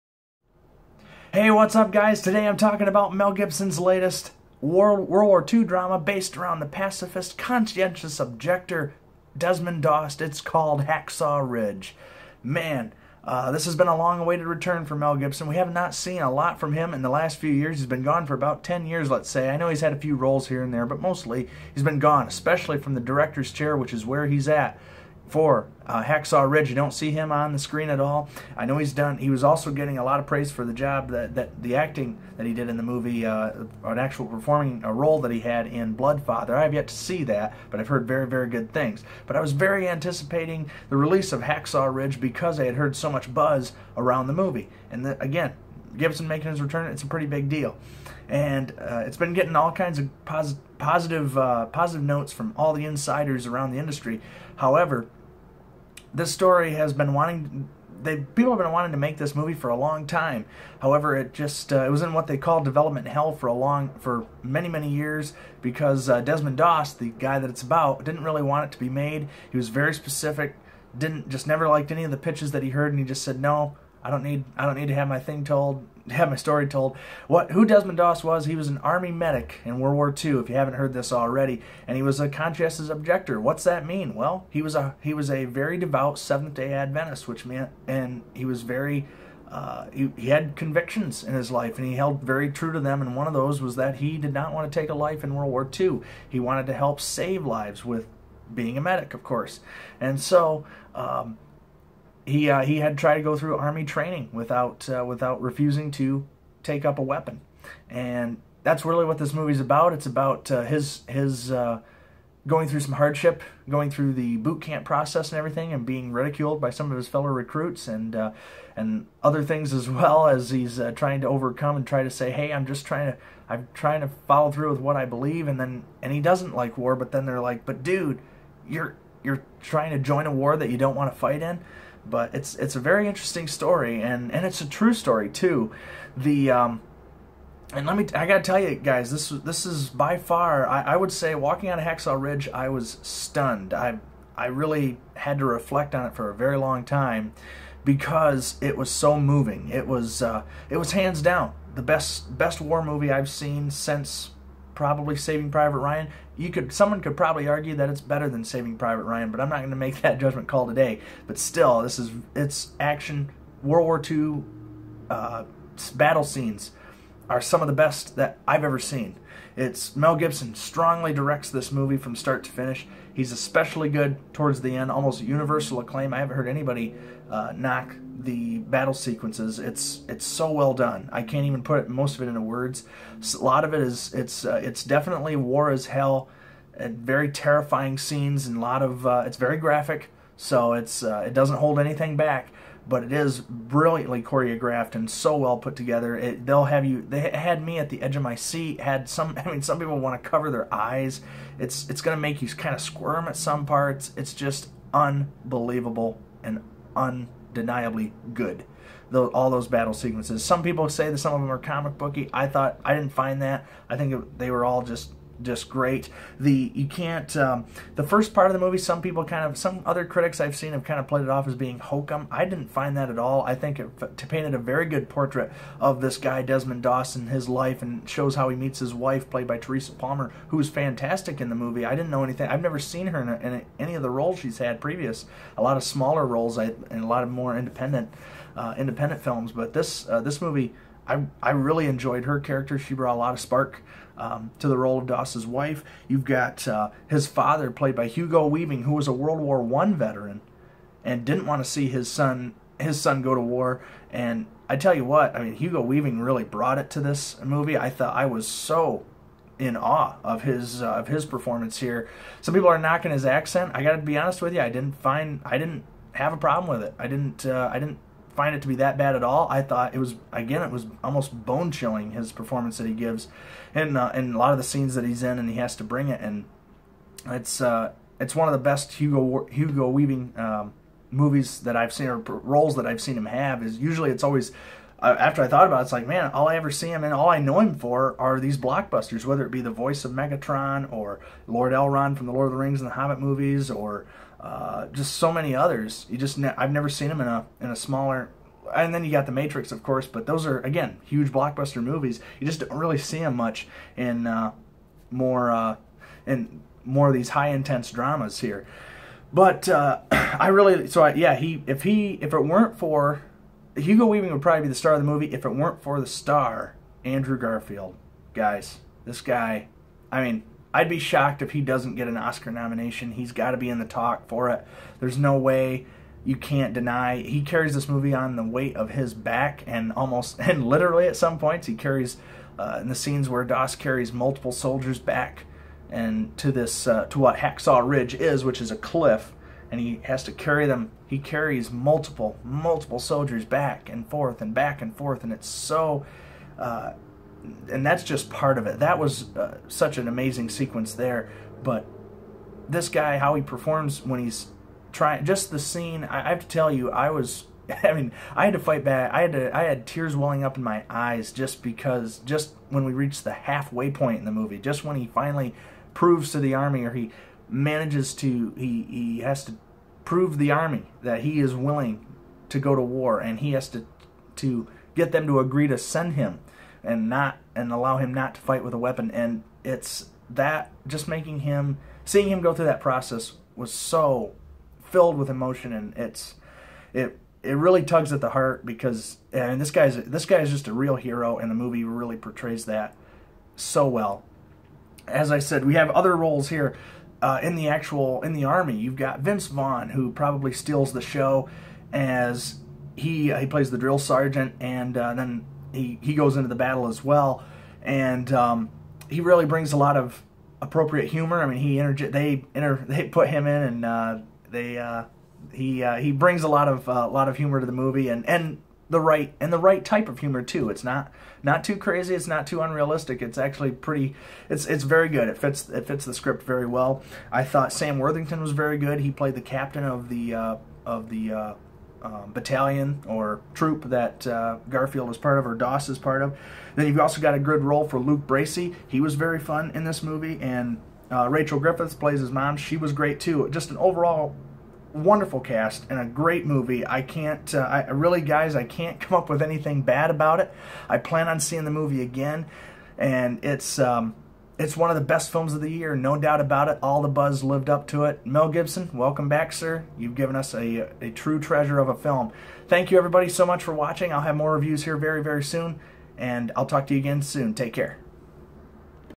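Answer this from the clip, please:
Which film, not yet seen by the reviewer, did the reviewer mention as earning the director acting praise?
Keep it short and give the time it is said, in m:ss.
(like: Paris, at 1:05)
Blood Father, at 0:35.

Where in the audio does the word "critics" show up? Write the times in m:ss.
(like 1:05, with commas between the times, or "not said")
3:40.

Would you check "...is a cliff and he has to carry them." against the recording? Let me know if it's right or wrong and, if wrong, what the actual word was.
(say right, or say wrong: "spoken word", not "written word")
right.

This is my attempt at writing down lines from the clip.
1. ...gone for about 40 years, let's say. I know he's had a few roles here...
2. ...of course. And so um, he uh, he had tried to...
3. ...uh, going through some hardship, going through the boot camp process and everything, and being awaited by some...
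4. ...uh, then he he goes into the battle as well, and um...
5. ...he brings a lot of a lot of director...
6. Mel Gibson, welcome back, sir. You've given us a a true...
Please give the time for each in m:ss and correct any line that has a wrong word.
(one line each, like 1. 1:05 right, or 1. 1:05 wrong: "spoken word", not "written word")
1. 0:18 wrong: "10", not "40"
2. 1:39 right
3. 1:51 wrong: "ridiculed", not "awaited"
4. 6:44 right
5. 6:55 wrong: "humor", not "director"
6. 7:38 right.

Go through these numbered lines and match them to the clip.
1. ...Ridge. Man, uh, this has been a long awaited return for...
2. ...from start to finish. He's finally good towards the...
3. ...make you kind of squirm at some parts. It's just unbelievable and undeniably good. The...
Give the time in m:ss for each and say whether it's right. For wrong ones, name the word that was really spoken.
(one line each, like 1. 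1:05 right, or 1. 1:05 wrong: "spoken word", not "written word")
1. 0:11 right
2. 2:51 wrong: "especially", not "finally"
3. 3:22 right.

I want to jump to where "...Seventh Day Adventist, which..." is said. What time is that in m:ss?
1:26.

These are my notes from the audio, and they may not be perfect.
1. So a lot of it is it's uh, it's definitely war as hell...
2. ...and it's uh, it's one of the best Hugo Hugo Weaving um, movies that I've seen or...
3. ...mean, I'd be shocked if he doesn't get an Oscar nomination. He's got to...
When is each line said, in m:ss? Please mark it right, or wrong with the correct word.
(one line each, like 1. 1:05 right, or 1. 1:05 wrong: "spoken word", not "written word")
1. 3:03 right
2. 4:36 right
3. 5:20 right.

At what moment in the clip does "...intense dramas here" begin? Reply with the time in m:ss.
5:07.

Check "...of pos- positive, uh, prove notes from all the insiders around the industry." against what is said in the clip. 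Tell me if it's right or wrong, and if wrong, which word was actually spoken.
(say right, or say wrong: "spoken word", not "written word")
wrong: "positive", not "prove".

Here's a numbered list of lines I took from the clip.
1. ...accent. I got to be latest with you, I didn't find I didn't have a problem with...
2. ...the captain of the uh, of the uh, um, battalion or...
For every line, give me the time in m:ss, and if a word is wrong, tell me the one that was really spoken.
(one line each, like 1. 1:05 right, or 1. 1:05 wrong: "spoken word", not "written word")
1. 4:23 wrong: "honest", not "latest"
2. 7:09 right.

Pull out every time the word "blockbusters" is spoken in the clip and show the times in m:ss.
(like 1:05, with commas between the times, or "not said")
4:48, 5:01.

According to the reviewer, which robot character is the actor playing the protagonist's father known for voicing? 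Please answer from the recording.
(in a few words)
Megatron.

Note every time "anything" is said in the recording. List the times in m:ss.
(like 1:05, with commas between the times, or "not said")
3:11, 3:52, 7:29.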